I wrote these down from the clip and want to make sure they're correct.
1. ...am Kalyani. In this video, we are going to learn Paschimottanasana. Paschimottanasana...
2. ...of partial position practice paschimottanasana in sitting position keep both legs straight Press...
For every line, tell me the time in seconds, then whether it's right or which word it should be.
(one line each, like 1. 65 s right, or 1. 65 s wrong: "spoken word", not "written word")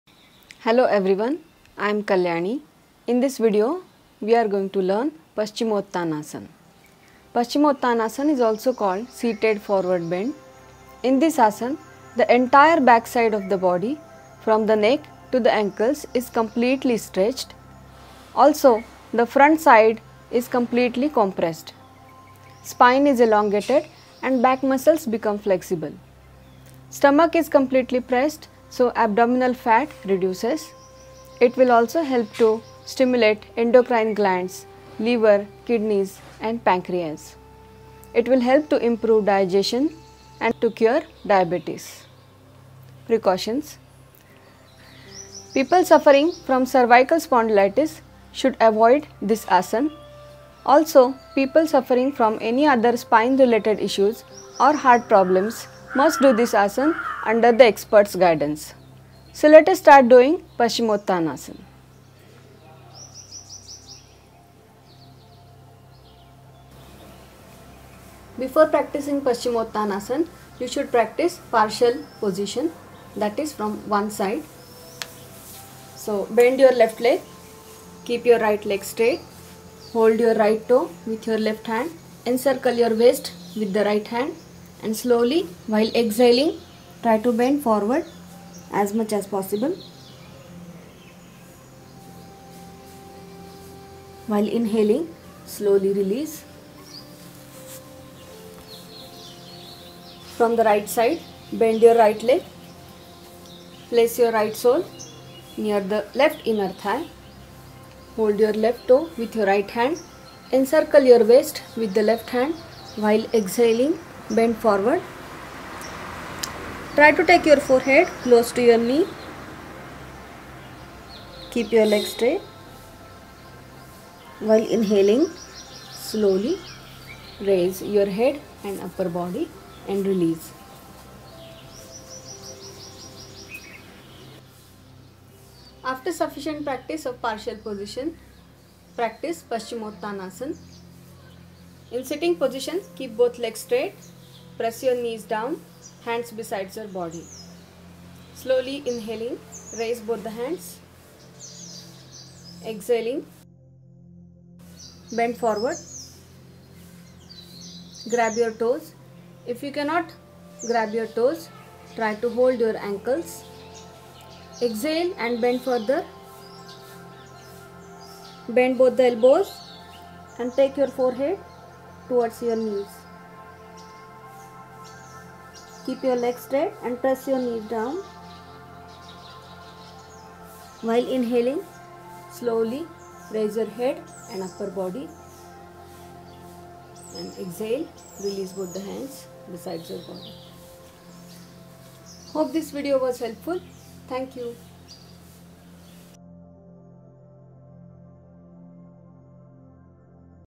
1. 1 s right
2. 137 s right.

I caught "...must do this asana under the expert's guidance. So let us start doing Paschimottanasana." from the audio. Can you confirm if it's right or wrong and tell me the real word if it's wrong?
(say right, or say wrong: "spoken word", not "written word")
right.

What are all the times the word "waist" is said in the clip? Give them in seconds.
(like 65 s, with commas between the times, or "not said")
82 s, 111 s.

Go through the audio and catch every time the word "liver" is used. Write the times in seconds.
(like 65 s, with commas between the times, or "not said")
34 s.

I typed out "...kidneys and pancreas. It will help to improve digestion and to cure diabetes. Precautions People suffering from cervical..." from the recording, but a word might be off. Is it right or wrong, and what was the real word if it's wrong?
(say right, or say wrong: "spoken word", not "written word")
right.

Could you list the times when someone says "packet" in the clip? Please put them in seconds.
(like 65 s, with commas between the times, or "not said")
not said.